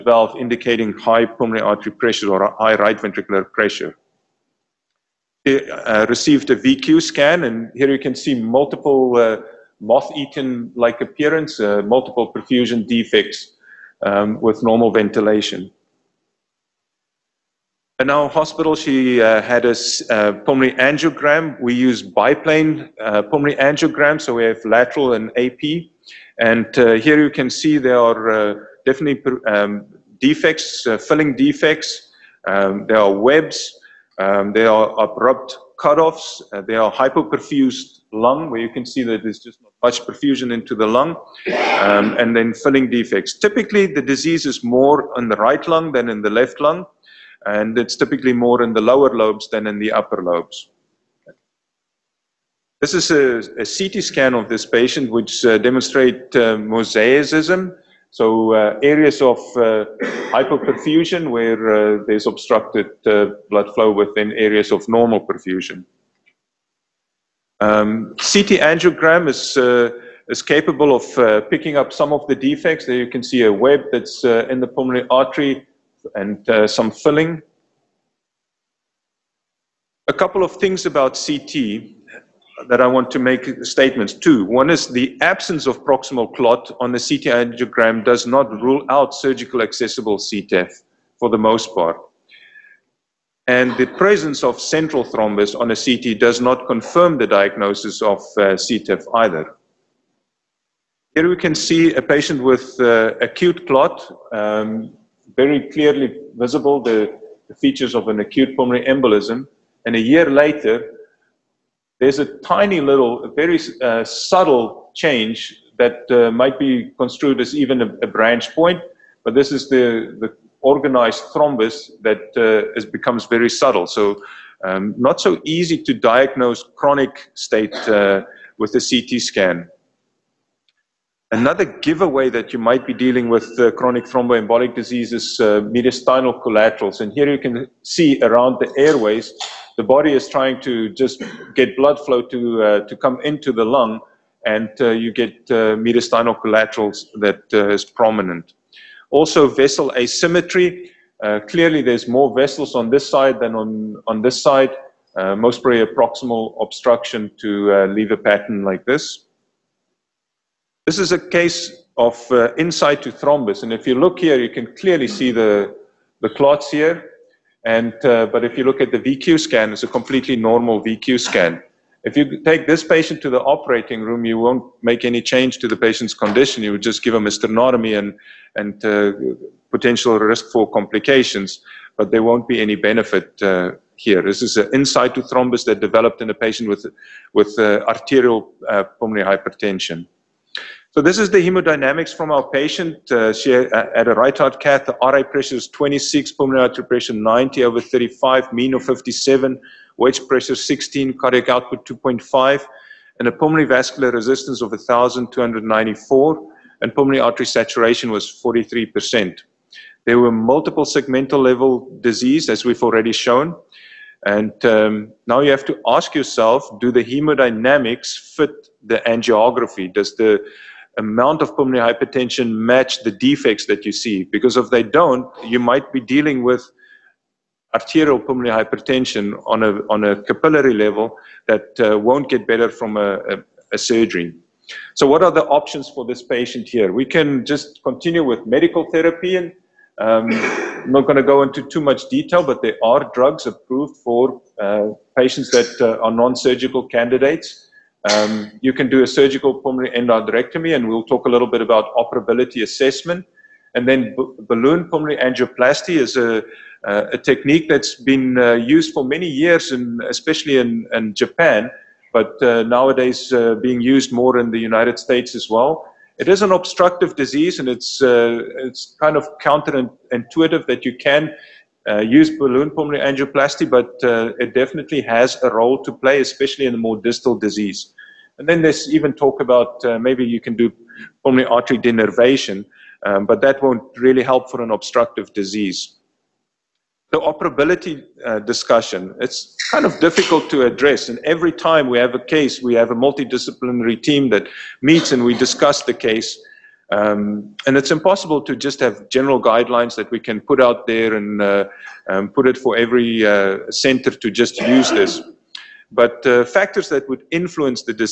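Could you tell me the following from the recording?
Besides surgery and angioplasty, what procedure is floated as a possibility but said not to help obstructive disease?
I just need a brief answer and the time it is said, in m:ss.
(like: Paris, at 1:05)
Pulmonary artery denervation, at 4:41.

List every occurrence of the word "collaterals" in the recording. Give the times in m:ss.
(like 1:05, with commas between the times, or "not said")
2:16, 2:26.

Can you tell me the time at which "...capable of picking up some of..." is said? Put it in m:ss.
1:10.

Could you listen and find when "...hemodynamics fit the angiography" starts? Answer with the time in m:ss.
3:37.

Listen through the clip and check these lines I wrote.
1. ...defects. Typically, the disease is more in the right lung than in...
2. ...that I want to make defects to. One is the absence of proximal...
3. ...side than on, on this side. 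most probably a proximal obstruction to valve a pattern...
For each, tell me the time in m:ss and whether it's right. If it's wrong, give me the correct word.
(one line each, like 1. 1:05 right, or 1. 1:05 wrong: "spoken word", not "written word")
1. 0:42 right
2. 1:22 wrong: "statements", not "defects"
3. 2:33 wrong: "leave", not "valve".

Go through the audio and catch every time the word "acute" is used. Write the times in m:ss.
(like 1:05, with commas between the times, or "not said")
1:43, 1:48.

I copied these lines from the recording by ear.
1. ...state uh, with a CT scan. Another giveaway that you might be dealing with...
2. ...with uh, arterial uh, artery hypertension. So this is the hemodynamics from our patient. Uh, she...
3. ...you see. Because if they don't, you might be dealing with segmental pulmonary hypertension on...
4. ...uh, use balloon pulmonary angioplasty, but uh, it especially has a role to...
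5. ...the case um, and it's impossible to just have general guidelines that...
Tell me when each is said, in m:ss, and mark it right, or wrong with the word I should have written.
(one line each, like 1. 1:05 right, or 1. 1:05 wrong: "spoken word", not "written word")
1. 2:07 right
2. 3:07 wrong: "pulmonary", not "artery"
3. 3:43 wrong: "arterial", not "segmental"
4. 4:31 wrong: "definitely", not "especially"
5. 4:55 right.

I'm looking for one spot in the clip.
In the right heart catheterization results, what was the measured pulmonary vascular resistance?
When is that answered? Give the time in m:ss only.
3:24.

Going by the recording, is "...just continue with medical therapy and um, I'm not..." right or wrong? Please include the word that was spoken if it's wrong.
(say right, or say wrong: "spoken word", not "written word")
right.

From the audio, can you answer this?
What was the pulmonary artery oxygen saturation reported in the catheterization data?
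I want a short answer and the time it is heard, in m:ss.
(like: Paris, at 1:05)
43%, at 3:28.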